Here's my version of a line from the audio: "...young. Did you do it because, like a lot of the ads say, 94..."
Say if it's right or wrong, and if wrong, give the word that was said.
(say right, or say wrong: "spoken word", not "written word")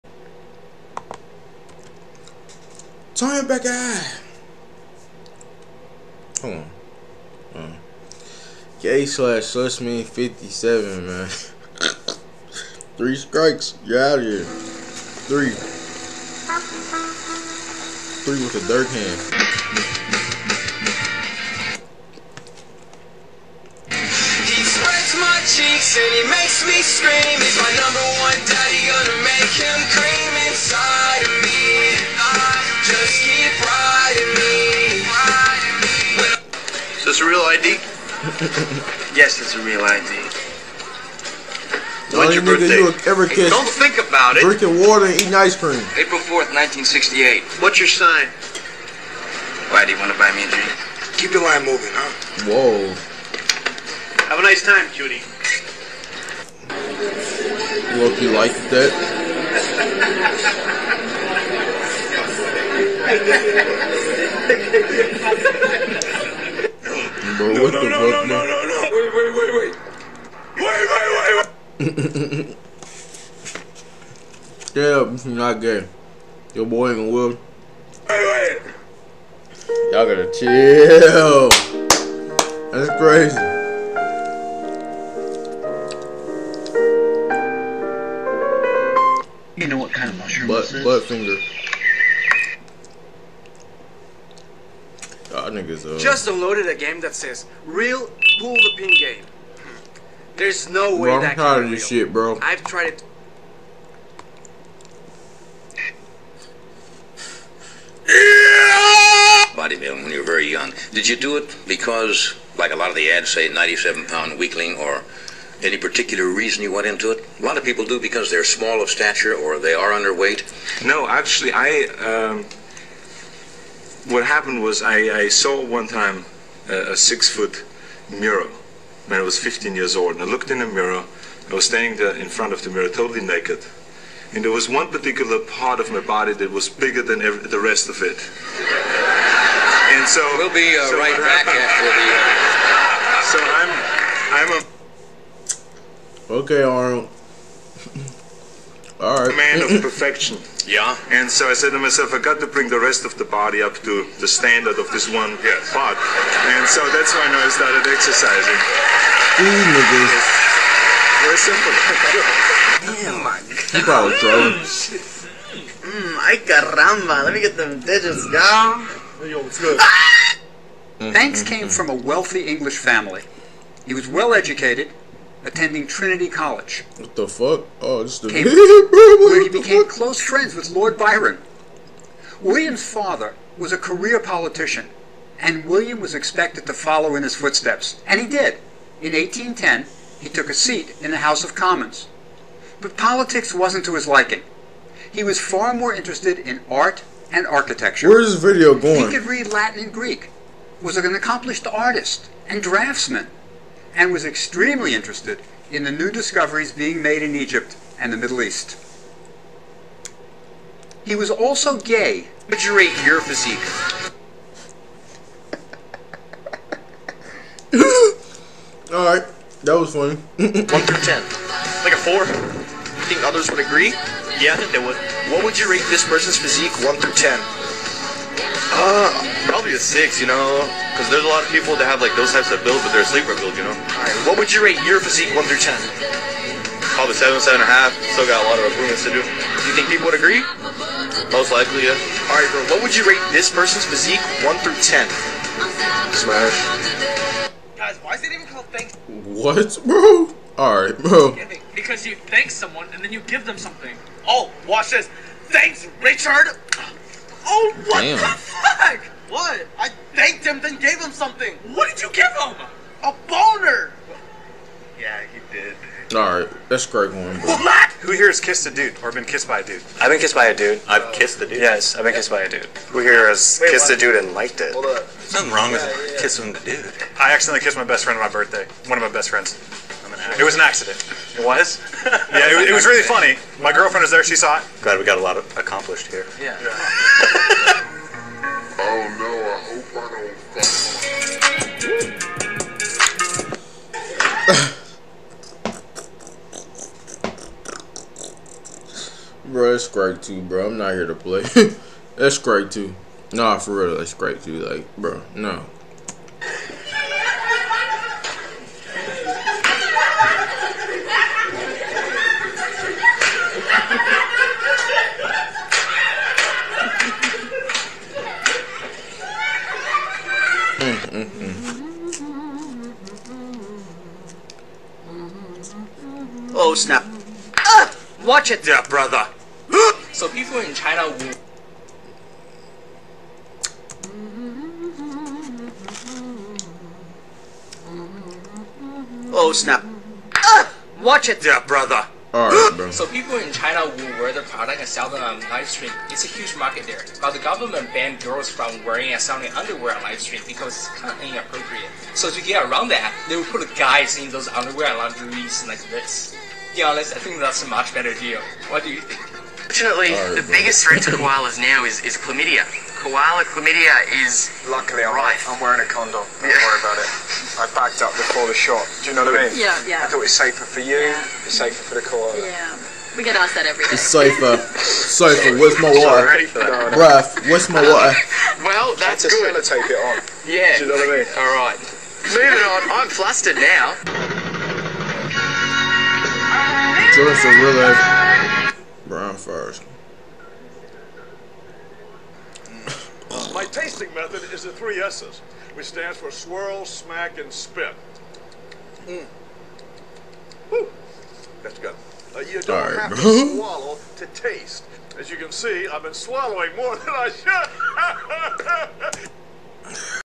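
wrong: "97", not "94".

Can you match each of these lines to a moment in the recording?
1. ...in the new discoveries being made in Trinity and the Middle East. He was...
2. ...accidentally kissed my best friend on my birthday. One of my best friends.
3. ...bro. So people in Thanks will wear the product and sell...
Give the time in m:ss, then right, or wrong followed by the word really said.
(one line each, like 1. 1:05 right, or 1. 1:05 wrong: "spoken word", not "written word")
1. 3:25 wrong: "Egypt", not "Trinity"
2. 4:37 right
3. 5:42 wrong: "China", not "Thanks".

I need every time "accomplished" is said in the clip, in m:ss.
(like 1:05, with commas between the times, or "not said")
3:21, 4:45.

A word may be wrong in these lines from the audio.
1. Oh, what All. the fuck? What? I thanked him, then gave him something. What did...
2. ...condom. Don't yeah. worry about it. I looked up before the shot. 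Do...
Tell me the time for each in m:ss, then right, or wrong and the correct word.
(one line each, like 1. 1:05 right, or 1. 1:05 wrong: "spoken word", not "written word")
1. 4:17 wrong: "Damn", not "All"
2. 6:05 wrong: "backed", not "looked".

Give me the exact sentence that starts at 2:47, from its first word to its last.
Let me get them digits, y'all.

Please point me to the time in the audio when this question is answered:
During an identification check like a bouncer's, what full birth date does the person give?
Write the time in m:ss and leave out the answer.
0:45.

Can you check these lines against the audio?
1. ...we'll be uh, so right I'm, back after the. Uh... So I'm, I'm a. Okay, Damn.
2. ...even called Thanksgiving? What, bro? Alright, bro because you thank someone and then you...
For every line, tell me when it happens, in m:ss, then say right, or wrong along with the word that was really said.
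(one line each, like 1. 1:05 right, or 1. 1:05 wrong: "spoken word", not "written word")
1. 2:20 wrong: "Arnold", not "Damn"
2. 4:08 right.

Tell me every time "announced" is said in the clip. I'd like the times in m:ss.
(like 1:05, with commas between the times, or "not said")
not said.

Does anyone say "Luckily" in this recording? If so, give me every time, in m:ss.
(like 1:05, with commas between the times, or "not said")
6:04.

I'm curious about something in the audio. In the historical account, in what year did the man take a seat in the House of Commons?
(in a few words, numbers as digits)
1810.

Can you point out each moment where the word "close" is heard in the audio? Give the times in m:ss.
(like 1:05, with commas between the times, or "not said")
2:59.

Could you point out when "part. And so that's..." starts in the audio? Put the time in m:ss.
2:35.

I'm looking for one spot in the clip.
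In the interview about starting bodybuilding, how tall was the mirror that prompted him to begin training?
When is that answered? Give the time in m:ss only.
2:06.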